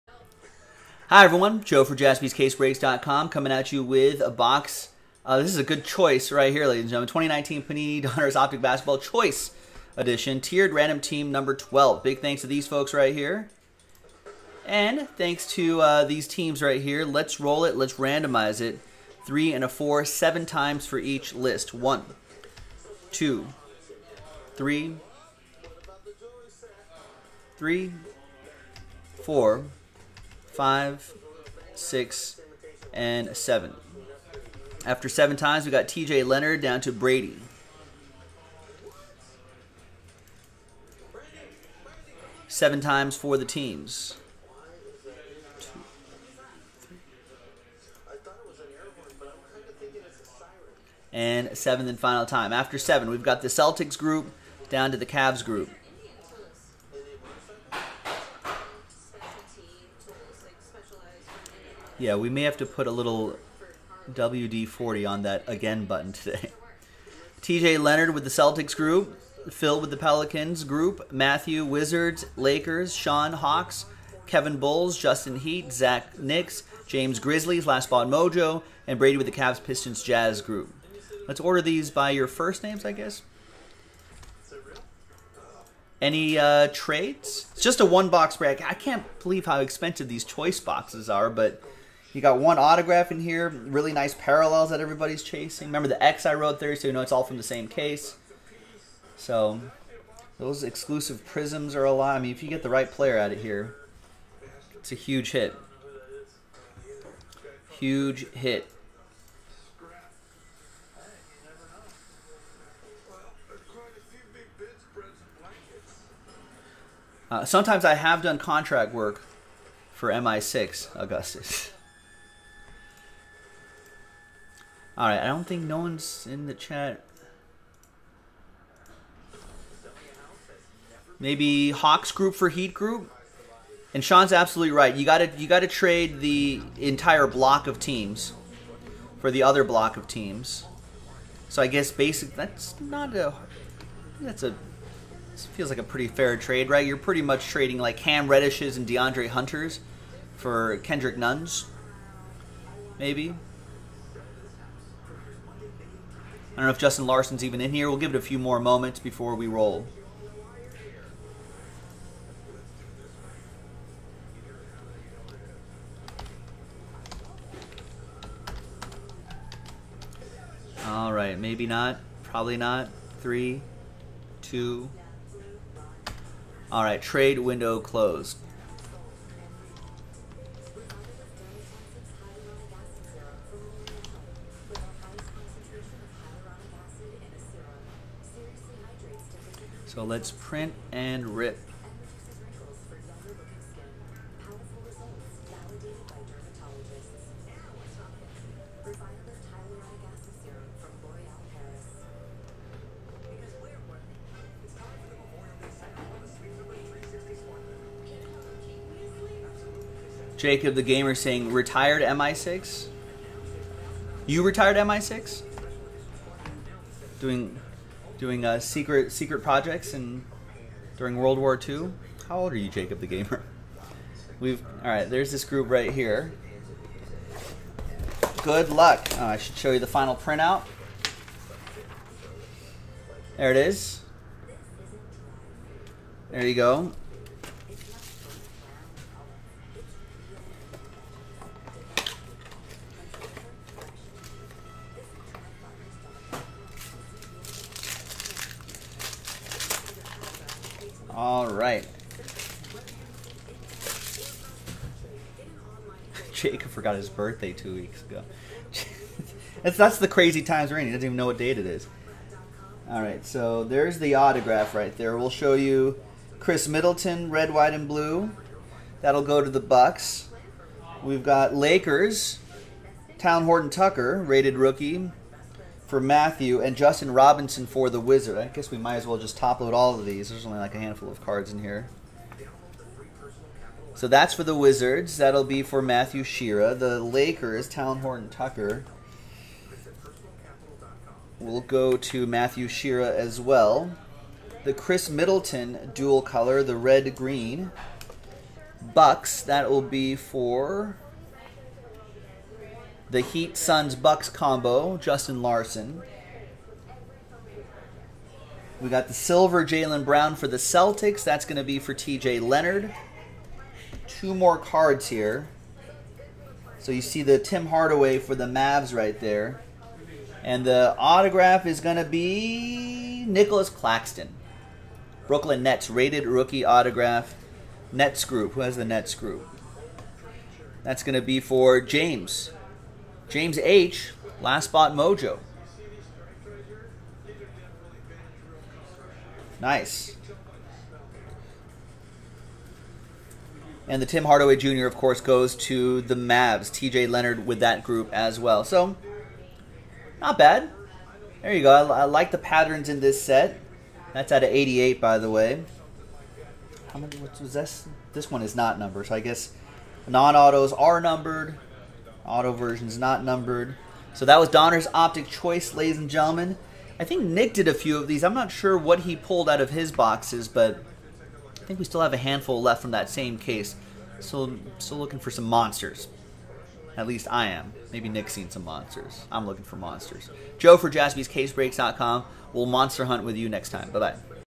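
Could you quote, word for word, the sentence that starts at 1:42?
I mean, if you get the right player out of here, it's a huge hit.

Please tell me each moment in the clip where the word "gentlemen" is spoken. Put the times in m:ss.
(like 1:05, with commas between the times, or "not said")
0:07, 6:06.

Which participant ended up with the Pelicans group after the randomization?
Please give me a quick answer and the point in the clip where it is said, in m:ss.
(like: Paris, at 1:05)
Phil, at 1:09.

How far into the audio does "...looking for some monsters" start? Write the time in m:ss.
6:14.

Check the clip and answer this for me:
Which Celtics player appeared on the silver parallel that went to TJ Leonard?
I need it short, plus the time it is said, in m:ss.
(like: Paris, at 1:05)
Jaylen Brown, at 5:09.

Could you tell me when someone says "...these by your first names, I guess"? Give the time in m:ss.
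1:21.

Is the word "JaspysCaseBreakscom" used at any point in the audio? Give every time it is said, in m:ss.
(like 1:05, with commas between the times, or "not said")
0:01, 6:20.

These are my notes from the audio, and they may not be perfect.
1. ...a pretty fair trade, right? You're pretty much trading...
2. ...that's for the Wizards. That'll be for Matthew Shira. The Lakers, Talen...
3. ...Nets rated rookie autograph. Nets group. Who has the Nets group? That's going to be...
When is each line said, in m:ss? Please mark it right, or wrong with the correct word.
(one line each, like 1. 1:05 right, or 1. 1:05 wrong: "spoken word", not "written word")
1. 2:25 right
2. 4:44 right
3. 5:25 right.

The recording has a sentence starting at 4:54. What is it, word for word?
The Khris Middleton dual color, the red green.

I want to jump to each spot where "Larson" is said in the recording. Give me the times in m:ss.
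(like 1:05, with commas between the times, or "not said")
2:37, 5:05.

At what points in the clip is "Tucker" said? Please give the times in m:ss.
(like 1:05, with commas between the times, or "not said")
4:33, 4:48.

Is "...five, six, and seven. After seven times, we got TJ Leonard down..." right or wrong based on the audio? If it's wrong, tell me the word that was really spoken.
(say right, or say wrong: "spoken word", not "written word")
right.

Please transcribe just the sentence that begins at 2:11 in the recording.
Maybe Hawks group for Heat group?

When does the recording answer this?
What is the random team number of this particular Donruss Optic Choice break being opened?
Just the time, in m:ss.
0:11.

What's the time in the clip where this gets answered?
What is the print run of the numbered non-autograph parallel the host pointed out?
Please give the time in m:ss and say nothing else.
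5:54.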